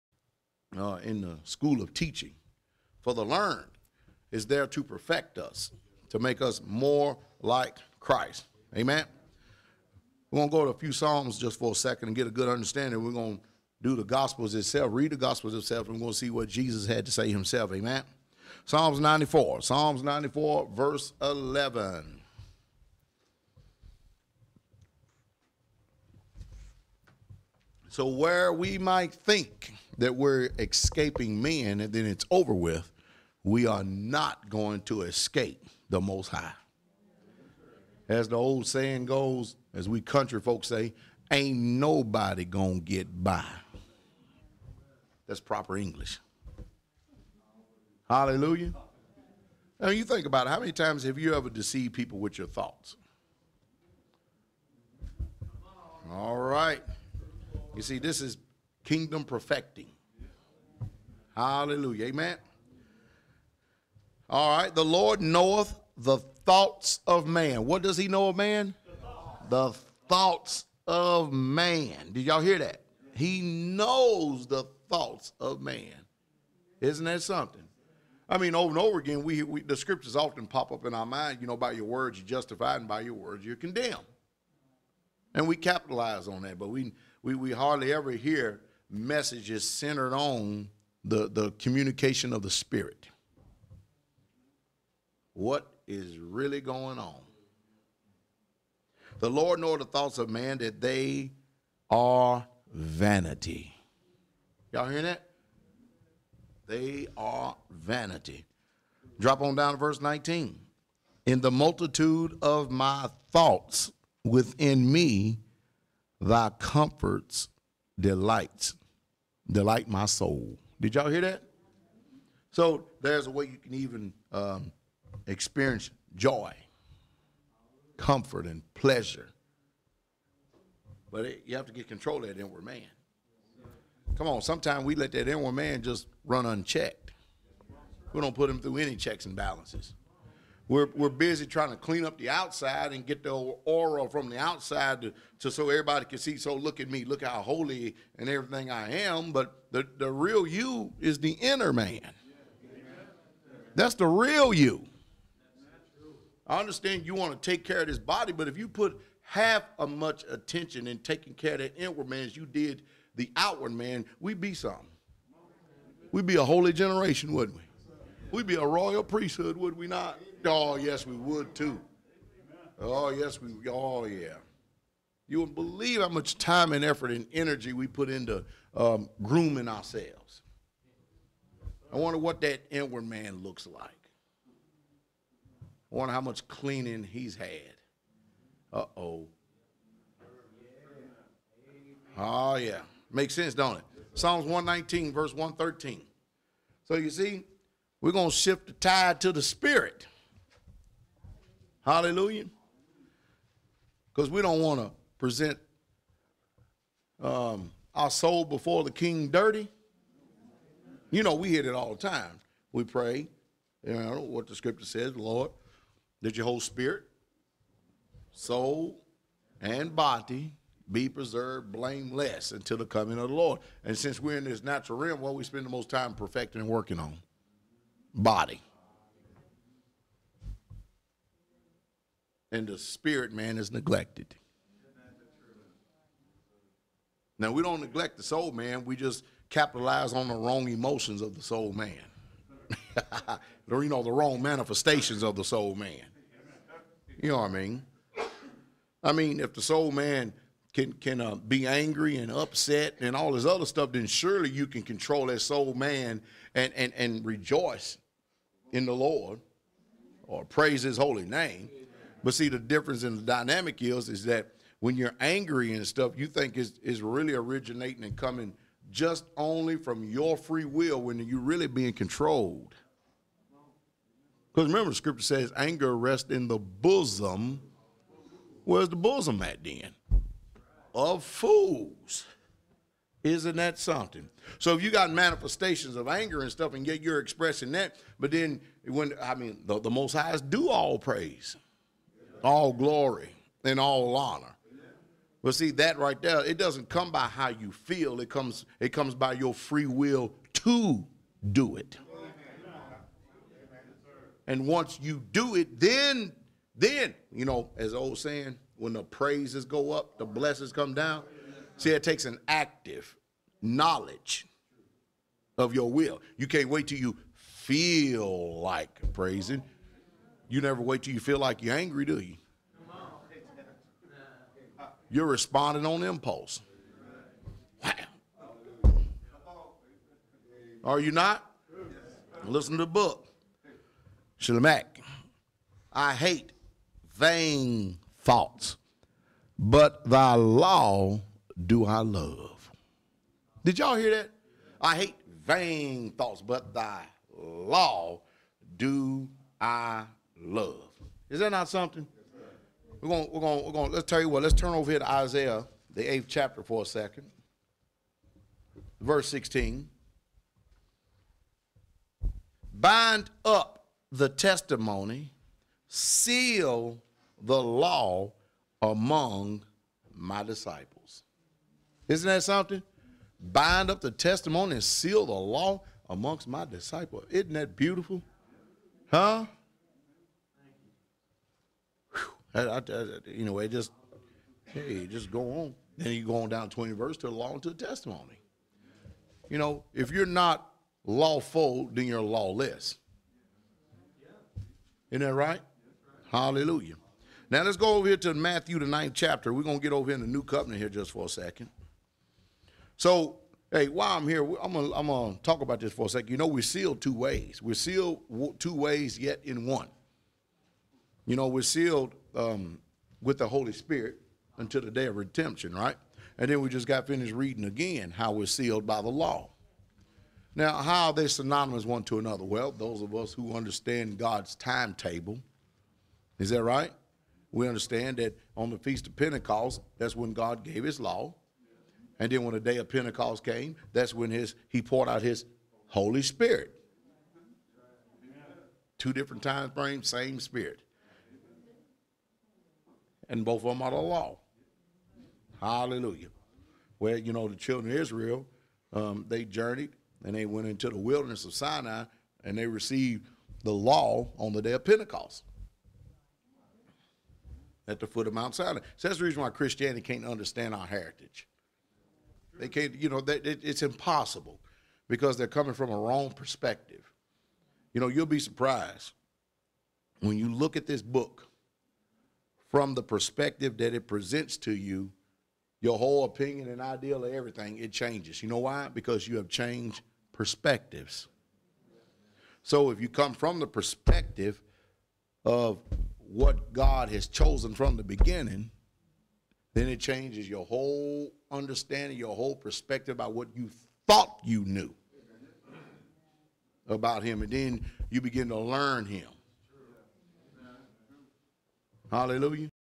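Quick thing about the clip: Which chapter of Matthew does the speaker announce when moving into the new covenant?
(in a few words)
9th chapter.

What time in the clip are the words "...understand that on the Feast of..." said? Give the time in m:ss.
7:07.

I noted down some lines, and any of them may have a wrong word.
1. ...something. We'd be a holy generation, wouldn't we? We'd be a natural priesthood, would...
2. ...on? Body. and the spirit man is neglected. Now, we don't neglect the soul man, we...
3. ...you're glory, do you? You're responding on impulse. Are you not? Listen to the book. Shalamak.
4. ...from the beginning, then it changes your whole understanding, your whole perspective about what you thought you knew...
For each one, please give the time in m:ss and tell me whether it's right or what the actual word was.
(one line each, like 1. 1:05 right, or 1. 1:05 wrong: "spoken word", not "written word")
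1. 2:44 wrong: "royal", not "natural"
2. 3:46 right
3. 5:21 wrong: "angry", not "glory"
4. 8:07 right.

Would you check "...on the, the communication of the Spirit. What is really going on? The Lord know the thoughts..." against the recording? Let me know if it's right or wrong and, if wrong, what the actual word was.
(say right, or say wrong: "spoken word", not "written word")
right.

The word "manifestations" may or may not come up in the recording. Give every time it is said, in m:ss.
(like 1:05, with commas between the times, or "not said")
4:04, 4:45.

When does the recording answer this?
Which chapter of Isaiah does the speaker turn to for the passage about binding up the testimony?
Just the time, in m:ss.
5:55.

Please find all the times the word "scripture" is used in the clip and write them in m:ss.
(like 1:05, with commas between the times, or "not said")
1:19, 3:34, 4:34.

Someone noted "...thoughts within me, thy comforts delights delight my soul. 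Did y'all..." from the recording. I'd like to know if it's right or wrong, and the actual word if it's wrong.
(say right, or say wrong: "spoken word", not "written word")
right.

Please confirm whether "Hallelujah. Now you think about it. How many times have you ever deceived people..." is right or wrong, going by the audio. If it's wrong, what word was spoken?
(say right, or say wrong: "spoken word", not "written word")
right.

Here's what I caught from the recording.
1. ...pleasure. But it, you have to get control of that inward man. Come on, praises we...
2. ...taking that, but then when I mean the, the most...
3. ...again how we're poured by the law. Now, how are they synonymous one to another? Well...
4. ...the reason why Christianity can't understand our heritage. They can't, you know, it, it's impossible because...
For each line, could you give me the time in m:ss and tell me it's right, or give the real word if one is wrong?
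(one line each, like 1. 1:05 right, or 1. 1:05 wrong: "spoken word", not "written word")
1. 2:08 wrong: "sometimes", not "praises"
2. 4:47 wrong: "expressing", not "taking"
3. 6:57 wrong: "sealed", not "poured"
4. 7:39 right.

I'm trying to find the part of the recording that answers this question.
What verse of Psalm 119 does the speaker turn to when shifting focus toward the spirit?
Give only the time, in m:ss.
3:15.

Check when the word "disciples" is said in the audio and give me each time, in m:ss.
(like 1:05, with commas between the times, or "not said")
6:10, 6:16.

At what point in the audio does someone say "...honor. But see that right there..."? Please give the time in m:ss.
4:54.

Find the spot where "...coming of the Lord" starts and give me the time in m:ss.
3:42.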